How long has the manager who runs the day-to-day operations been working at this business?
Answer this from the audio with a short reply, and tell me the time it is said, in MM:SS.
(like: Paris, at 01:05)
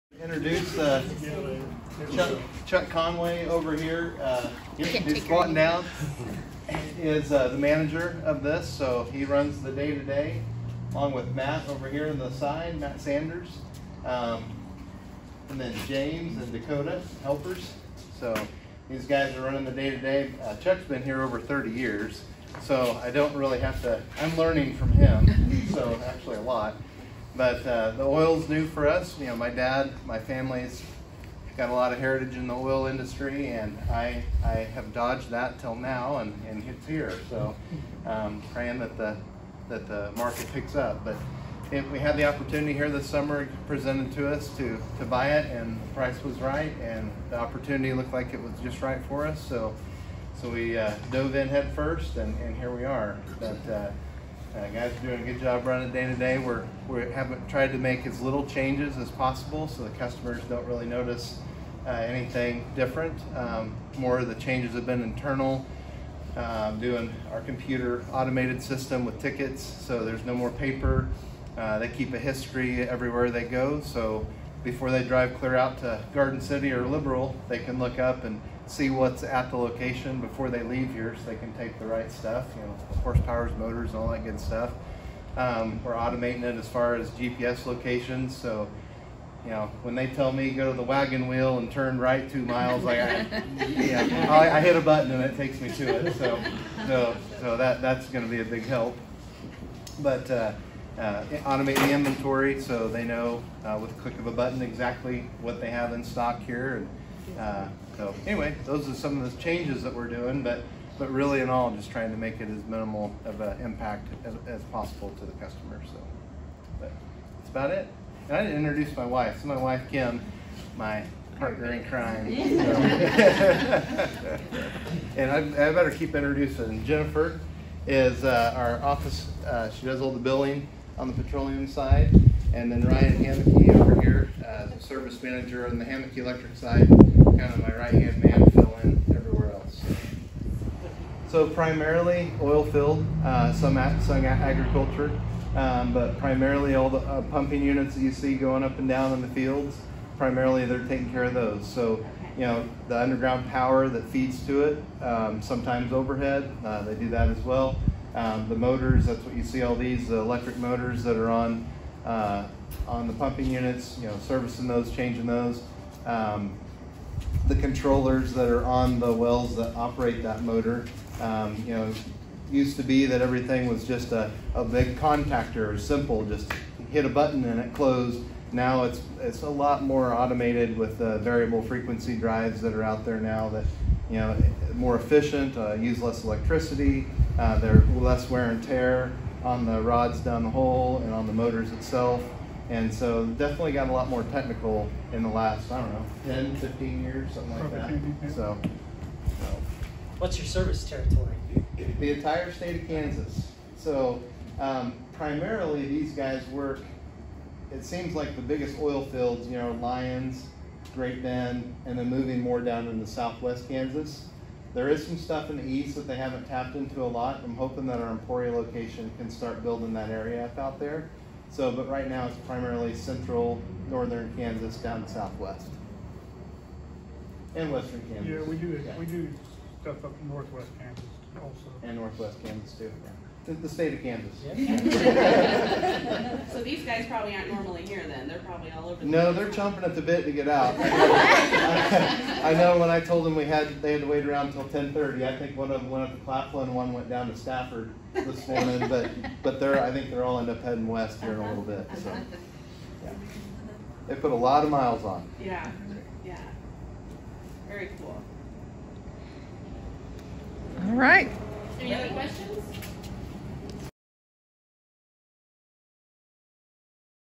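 over 30 years, at 00:21.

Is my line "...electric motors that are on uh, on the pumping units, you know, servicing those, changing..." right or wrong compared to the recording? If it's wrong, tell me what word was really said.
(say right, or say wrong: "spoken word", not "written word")
right.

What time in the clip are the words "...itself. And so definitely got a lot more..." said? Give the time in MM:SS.
03:11.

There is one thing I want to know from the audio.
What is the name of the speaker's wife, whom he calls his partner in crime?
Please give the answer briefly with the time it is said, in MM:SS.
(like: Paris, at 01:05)
Kim, at 01:59.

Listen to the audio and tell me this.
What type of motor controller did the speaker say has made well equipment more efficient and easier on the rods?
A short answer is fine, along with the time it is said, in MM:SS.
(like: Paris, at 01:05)
variable frequency drives, at 03:01.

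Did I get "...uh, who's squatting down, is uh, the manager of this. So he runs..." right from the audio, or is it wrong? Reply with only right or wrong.
right.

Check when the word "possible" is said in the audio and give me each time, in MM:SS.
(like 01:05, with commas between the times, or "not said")
00:59, 01:54.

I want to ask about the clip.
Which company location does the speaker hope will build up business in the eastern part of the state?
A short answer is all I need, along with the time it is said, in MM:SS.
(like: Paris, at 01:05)
Emporia, at 03:38.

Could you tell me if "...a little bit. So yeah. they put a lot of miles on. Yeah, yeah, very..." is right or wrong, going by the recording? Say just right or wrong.
right.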